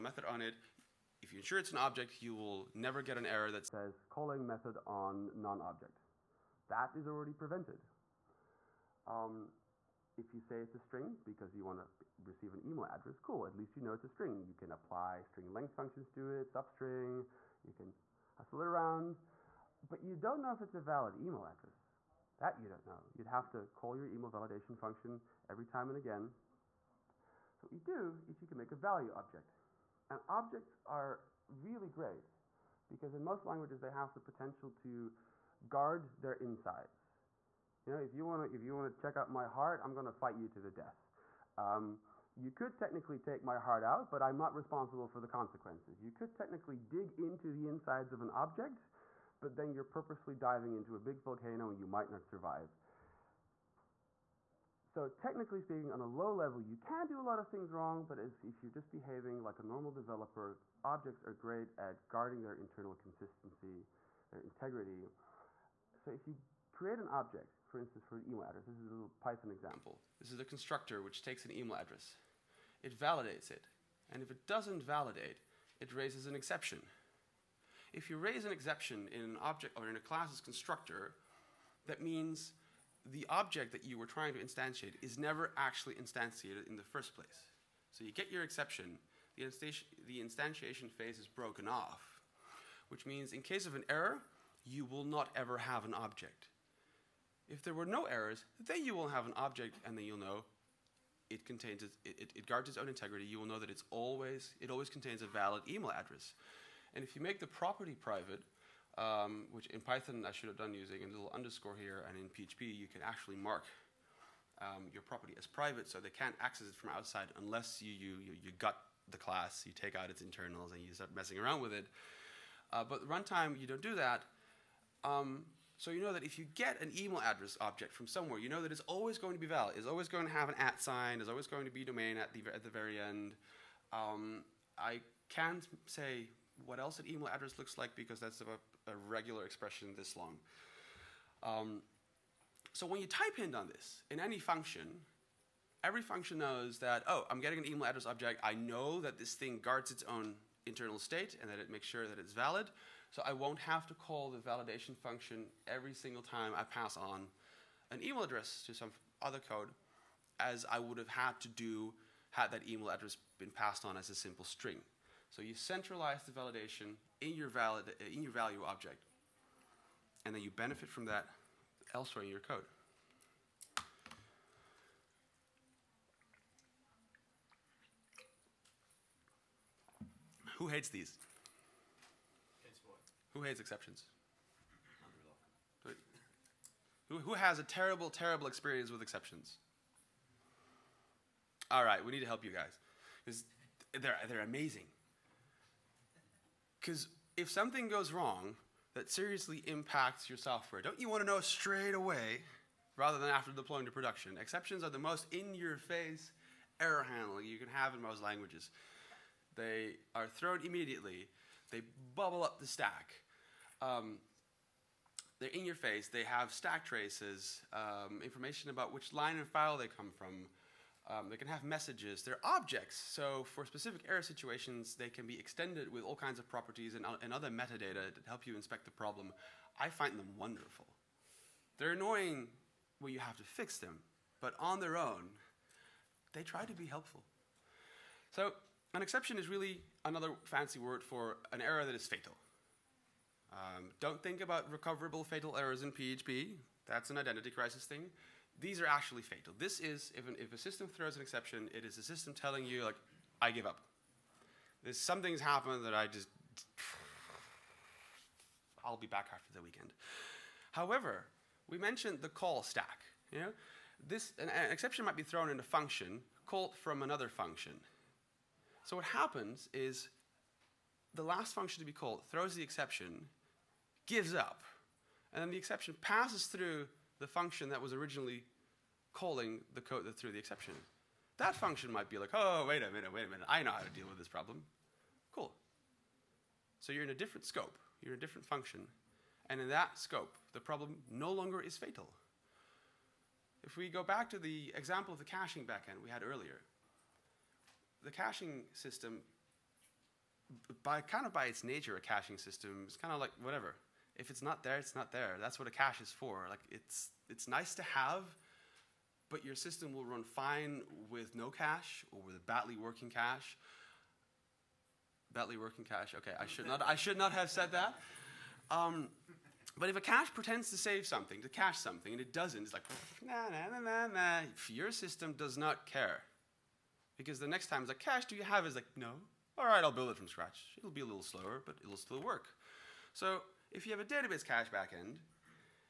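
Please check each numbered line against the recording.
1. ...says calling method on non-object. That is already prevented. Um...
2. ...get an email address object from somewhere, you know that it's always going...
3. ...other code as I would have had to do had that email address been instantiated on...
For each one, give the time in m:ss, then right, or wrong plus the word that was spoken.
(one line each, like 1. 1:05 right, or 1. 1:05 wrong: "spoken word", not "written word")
1. 0:03 right
2. 2:06 right
3. 2:39 wrong: "passed", not "instantiated".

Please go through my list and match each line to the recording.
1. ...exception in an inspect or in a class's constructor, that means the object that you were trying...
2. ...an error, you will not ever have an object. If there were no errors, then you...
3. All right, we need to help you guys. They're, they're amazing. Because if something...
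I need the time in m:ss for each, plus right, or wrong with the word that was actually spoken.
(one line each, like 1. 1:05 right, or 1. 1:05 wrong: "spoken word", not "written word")
1. 1:18 wrong: "object", not "inspect"
2. 1:33 right
3. 3:11 right.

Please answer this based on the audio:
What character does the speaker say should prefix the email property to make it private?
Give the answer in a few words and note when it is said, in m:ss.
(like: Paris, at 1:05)
Underscore, at 1:51.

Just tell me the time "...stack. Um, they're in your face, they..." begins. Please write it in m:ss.
3:32.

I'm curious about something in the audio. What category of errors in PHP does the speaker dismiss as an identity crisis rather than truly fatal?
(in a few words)
Recoverable fatal errors.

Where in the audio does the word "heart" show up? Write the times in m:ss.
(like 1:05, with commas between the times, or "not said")
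0:39, 0:43.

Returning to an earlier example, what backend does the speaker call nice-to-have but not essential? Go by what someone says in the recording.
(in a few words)
Caching backend.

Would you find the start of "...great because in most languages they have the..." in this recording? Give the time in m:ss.
0:31.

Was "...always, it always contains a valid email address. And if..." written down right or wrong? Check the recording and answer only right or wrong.
right.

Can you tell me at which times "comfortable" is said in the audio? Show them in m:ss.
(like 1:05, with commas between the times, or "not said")
not said.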